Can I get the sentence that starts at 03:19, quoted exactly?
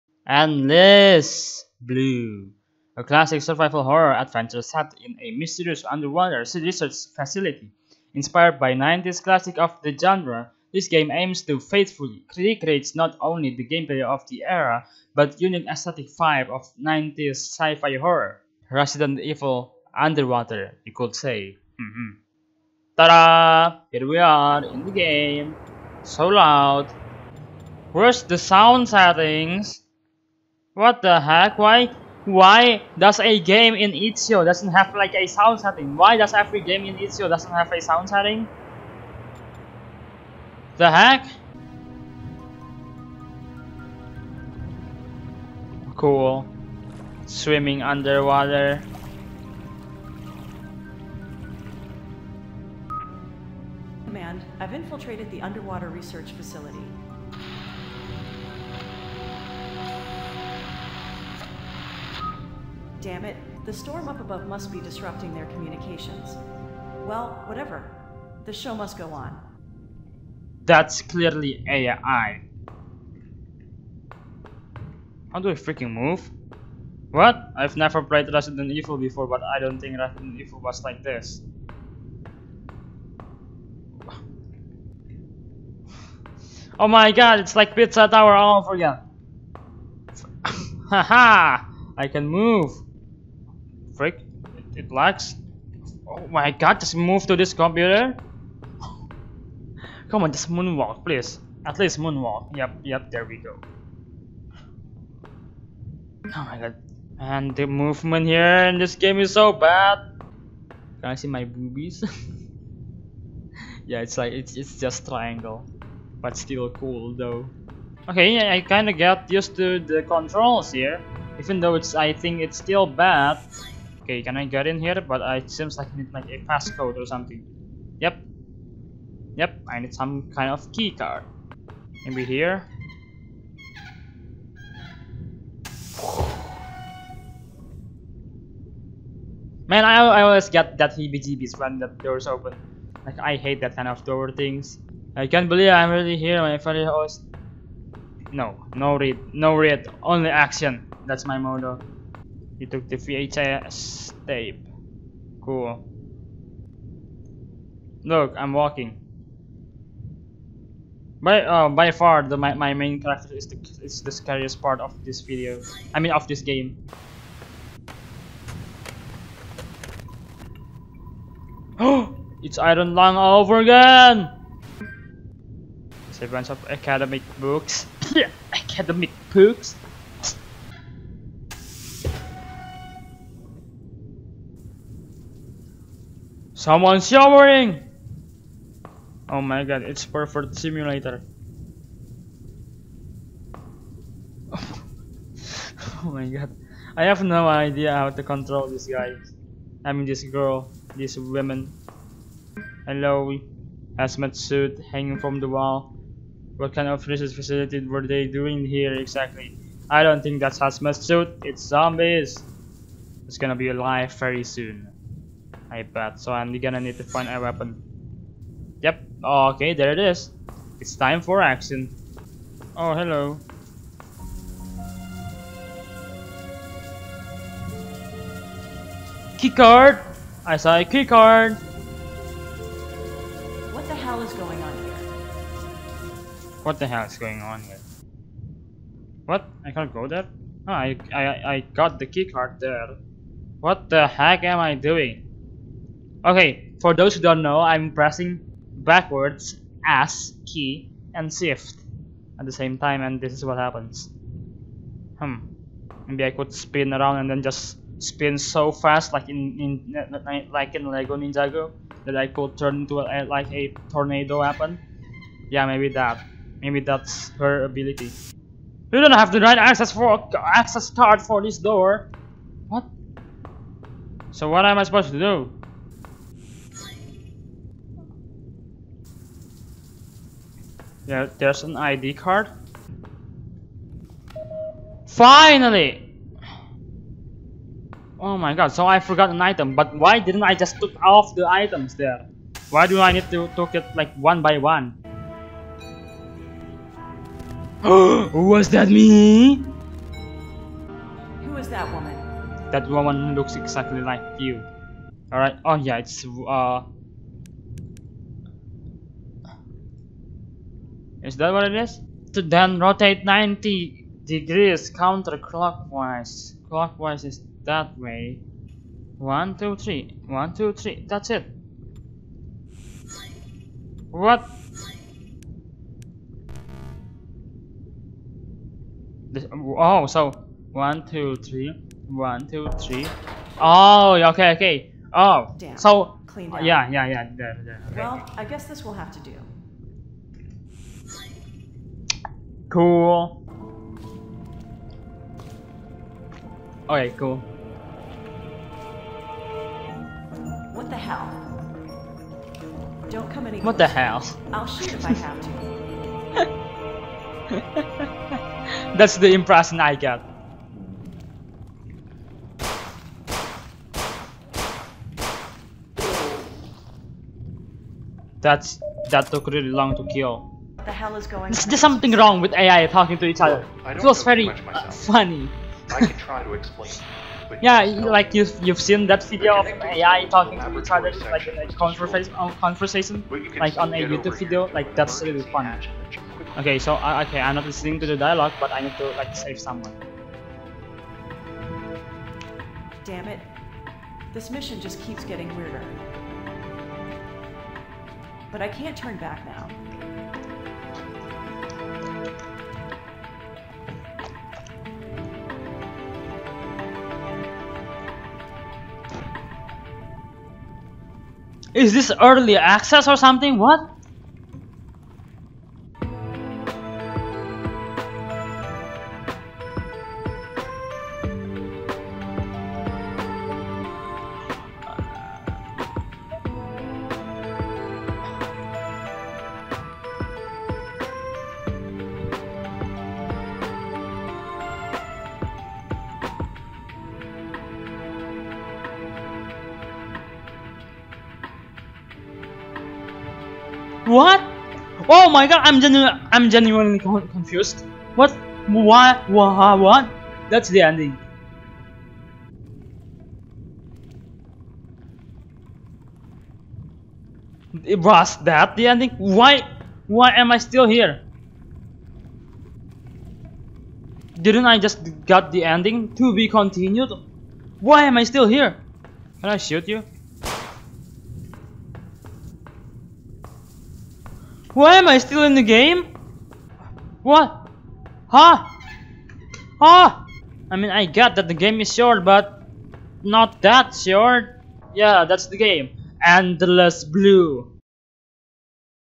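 I mean this girl, this woman.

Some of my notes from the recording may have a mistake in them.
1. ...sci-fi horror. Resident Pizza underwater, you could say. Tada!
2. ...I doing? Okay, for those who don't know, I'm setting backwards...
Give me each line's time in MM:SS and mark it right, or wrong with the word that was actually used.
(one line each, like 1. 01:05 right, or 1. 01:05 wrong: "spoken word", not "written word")
1. 00:17 wrong: "Evil", not "Pizza"
2. 04:04 wrong: "pressing", not "setting".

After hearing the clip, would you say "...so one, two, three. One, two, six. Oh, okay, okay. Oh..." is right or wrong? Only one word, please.
wrong.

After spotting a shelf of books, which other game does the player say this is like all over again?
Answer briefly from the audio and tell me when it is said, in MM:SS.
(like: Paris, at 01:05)
Iron Lung, at 02:52.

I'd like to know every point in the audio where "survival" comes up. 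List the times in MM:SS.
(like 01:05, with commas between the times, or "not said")
00:03.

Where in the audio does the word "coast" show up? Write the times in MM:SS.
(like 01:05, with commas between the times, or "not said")
not said.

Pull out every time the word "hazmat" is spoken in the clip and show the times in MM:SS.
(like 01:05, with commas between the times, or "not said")
03:23, 03:30.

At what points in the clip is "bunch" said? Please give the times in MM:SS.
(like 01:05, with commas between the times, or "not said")
02:56.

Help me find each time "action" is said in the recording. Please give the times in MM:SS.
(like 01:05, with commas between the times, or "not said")
02:30, 03:41.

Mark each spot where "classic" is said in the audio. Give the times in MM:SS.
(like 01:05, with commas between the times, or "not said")
00:03, 00:09.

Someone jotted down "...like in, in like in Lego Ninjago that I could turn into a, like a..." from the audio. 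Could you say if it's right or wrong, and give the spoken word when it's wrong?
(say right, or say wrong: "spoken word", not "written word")
right.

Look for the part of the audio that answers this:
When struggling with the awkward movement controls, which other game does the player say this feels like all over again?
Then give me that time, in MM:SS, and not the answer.
01:27.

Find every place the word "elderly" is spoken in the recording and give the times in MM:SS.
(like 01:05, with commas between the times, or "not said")
not said.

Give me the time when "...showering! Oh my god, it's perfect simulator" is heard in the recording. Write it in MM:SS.
03:07.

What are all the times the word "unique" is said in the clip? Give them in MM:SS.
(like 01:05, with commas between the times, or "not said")
00:15.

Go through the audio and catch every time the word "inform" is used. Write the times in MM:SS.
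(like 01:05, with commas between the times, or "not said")
not said.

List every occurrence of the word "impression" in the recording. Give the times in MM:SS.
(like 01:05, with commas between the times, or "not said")
05:59.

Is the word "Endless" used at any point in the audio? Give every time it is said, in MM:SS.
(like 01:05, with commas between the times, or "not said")
00:00, 08:06.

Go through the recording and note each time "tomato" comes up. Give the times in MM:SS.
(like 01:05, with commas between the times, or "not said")
not said.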